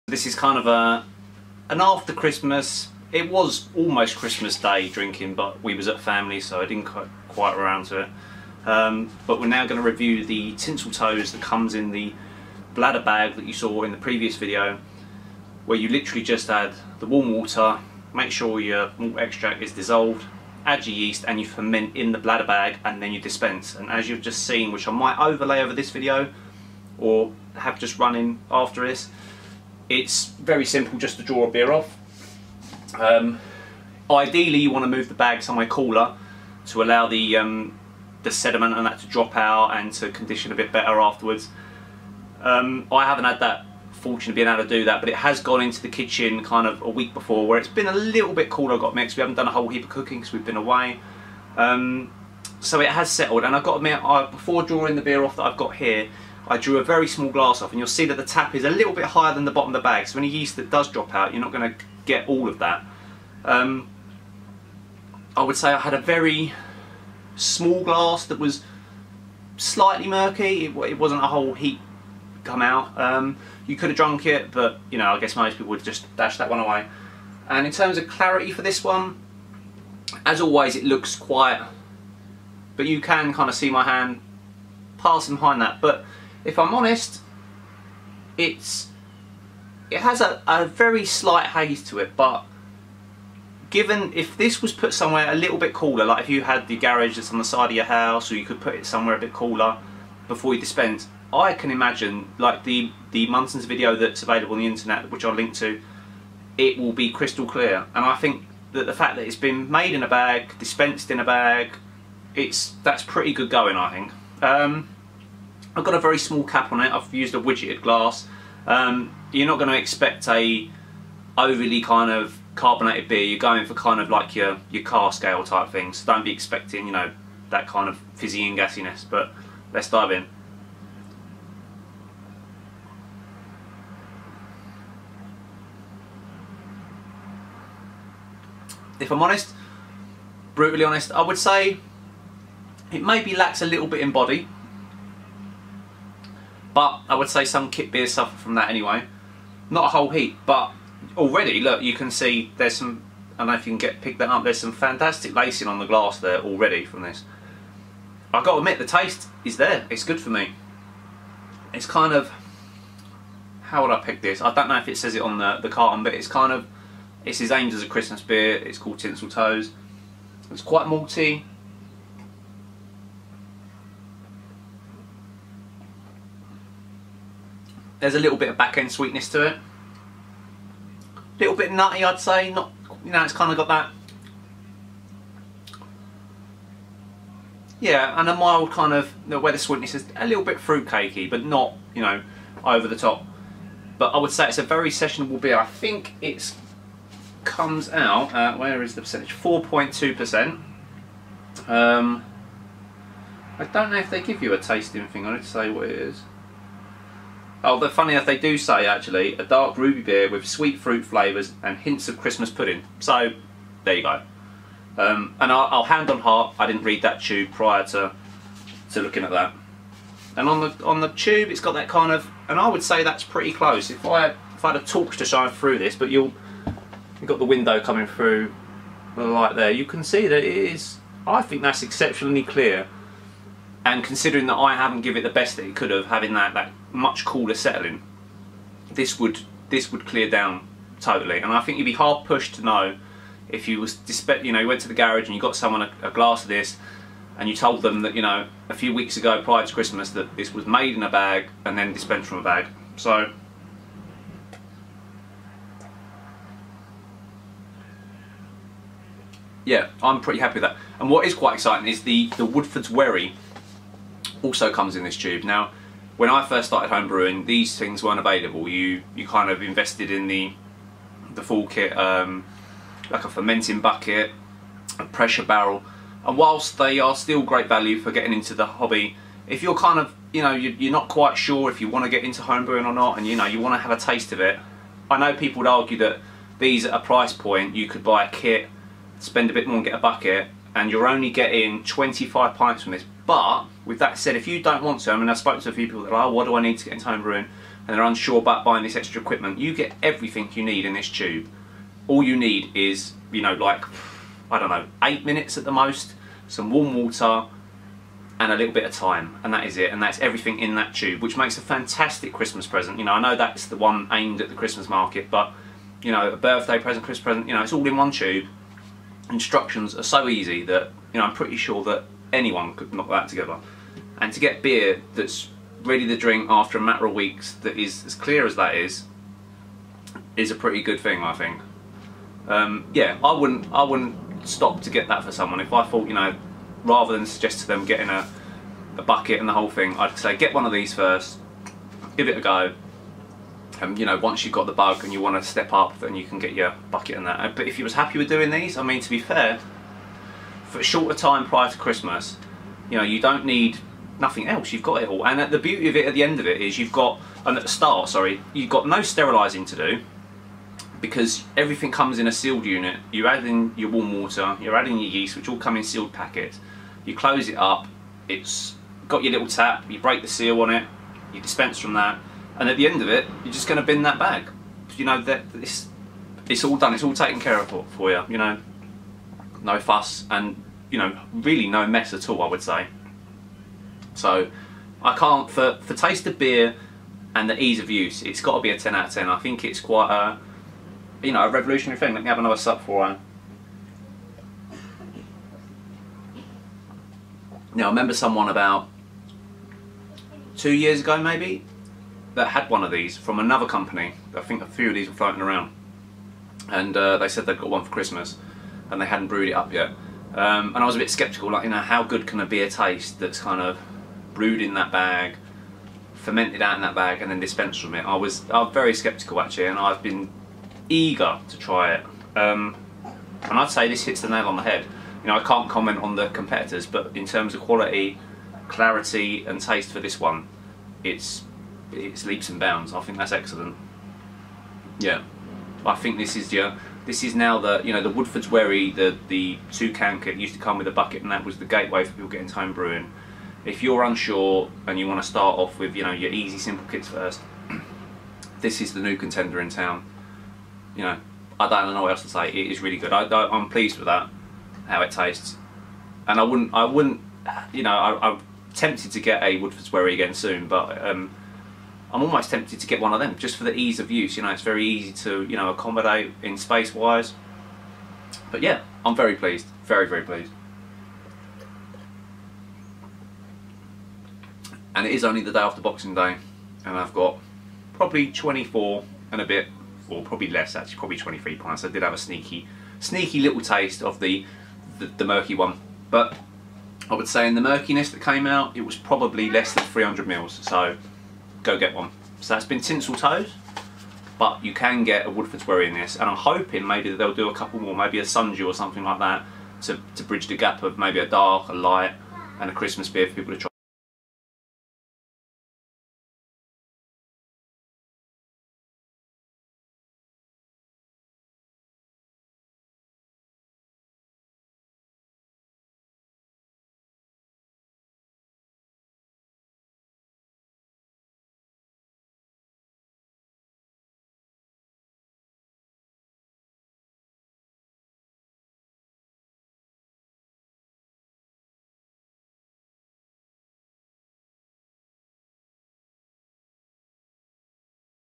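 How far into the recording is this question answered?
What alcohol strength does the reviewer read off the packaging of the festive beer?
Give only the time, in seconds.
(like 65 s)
199 s.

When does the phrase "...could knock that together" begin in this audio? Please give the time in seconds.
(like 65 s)
322 s.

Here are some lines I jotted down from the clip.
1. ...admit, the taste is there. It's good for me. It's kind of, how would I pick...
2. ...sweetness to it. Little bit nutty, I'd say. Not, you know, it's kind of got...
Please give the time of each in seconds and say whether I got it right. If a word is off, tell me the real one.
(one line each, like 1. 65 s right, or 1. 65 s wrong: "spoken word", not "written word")
1. 158 s right
2. 178 s right.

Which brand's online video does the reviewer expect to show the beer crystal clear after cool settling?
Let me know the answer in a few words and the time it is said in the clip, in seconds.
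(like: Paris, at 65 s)
Muntons, at 103 s.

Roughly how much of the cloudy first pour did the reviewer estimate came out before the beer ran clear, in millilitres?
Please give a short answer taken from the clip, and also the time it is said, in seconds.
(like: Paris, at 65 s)
less than 300 ml, at 489 s.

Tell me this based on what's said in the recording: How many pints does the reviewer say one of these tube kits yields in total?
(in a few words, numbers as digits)
25.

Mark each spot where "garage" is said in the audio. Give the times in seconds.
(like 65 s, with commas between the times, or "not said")
96 s, 244 s.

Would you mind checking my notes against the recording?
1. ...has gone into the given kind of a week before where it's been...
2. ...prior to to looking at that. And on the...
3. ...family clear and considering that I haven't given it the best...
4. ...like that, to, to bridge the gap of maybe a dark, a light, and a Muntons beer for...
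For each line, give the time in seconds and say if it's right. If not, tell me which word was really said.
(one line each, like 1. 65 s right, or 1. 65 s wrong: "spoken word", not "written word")
1. 45 s wrong: "kitchen", not "given"
2. 217 s right
3. 231 s wrong: "exceptionally", not "family"
4. 499 s wrong: "Christmas", not "Muntons".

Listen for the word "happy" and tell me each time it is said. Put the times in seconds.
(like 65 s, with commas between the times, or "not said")
260 s, 347 s.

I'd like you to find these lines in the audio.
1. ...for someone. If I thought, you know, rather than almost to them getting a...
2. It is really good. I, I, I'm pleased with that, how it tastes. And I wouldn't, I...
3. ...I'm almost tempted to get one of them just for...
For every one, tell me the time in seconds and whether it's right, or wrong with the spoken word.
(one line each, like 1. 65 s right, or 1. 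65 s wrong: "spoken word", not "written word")
1. 335 s wrong: "suggest", not "almost"
2. 452 s right
3. 462 s right.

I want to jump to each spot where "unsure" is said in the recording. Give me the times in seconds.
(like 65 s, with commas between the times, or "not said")
298 s, 444 s.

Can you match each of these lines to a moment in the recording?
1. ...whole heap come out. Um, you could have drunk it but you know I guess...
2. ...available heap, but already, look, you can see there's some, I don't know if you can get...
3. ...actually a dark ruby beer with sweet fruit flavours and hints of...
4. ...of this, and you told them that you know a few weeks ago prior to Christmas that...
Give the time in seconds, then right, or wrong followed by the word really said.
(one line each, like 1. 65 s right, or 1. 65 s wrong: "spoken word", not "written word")
1. 71 s right
2. 149 s wrong: "whole", not "available"
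3. 208 s right
4. 246 s right.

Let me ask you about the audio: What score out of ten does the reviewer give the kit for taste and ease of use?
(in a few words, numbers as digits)
10.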